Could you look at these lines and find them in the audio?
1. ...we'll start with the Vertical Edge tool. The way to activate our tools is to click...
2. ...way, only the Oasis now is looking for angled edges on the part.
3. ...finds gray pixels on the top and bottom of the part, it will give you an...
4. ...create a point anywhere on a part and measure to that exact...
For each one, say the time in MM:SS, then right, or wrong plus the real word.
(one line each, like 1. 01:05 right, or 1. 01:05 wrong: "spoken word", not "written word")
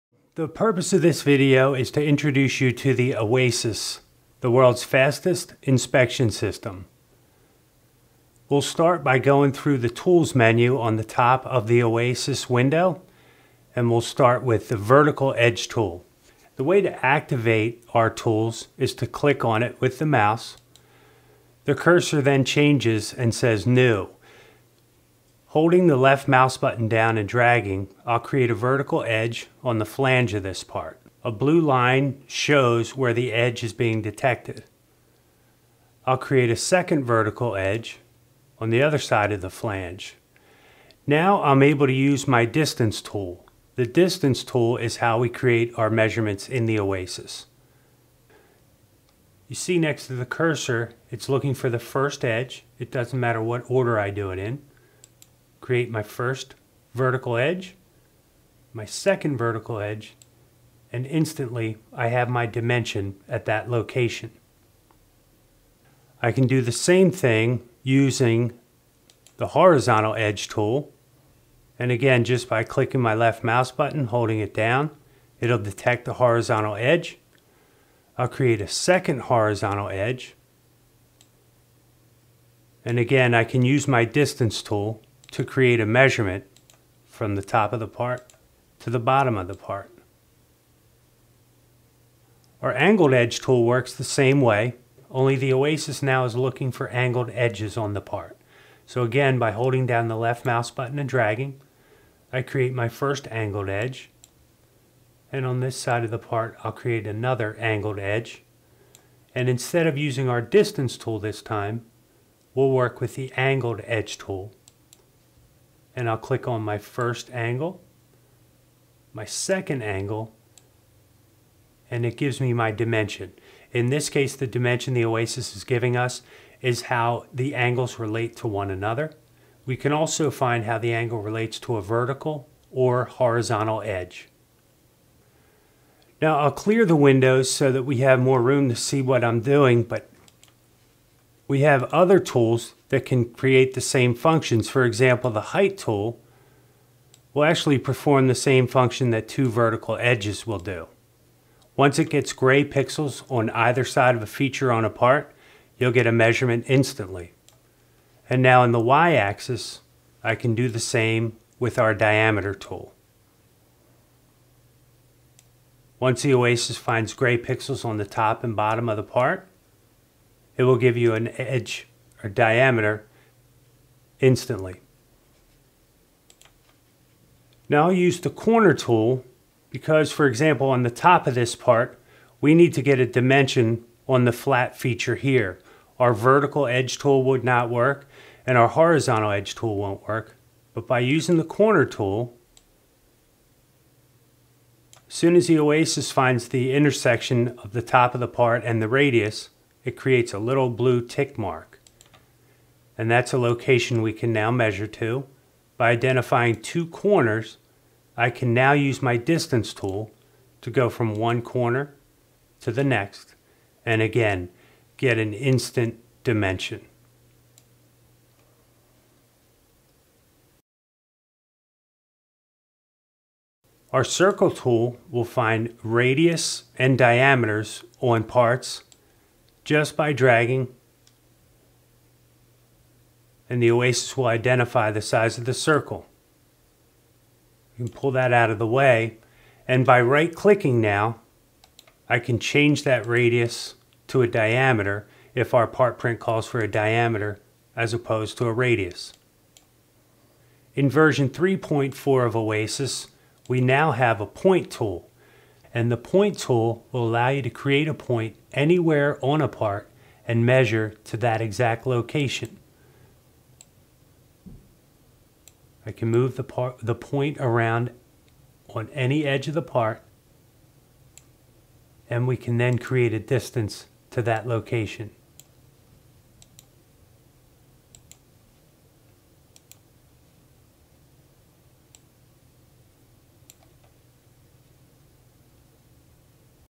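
1. 00:13 right
2. 01:34 right
3. 02:46 right
4. 04:17 right.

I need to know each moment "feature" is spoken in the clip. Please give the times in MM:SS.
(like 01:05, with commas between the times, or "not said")
02:34, 03:04.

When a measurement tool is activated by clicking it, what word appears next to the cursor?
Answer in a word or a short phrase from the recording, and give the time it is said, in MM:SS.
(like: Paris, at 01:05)
New, at 00:23.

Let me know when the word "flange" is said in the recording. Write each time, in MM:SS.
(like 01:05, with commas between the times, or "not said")
00:29, 00:39.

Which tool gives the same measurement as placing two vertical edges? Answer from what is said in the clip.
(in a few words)
Height tool.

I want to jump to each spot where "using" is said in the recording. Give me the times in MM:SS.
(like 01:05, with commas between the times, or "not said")
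01:07, 01:49, 03:10.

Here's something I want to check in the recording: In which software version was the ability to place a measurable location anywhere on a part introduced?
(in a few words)
3.4.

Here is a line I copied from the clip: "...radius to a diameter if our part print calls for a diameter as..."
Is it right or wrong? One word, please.
right.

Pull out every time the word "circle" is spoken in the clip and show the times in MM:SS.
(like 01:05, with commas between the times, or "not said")
03:44, 03:55.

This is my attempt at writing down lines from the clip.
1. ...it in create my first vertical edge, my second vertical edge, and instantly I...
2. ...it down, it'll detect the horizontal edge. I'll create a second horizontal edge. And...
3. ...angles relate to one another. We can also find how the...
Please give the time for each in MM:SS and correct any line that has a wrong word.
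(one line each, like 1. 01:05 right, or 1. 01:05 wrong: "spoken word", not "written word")
1. 00:54 right
2. 01:14 right
3. 02:07 right.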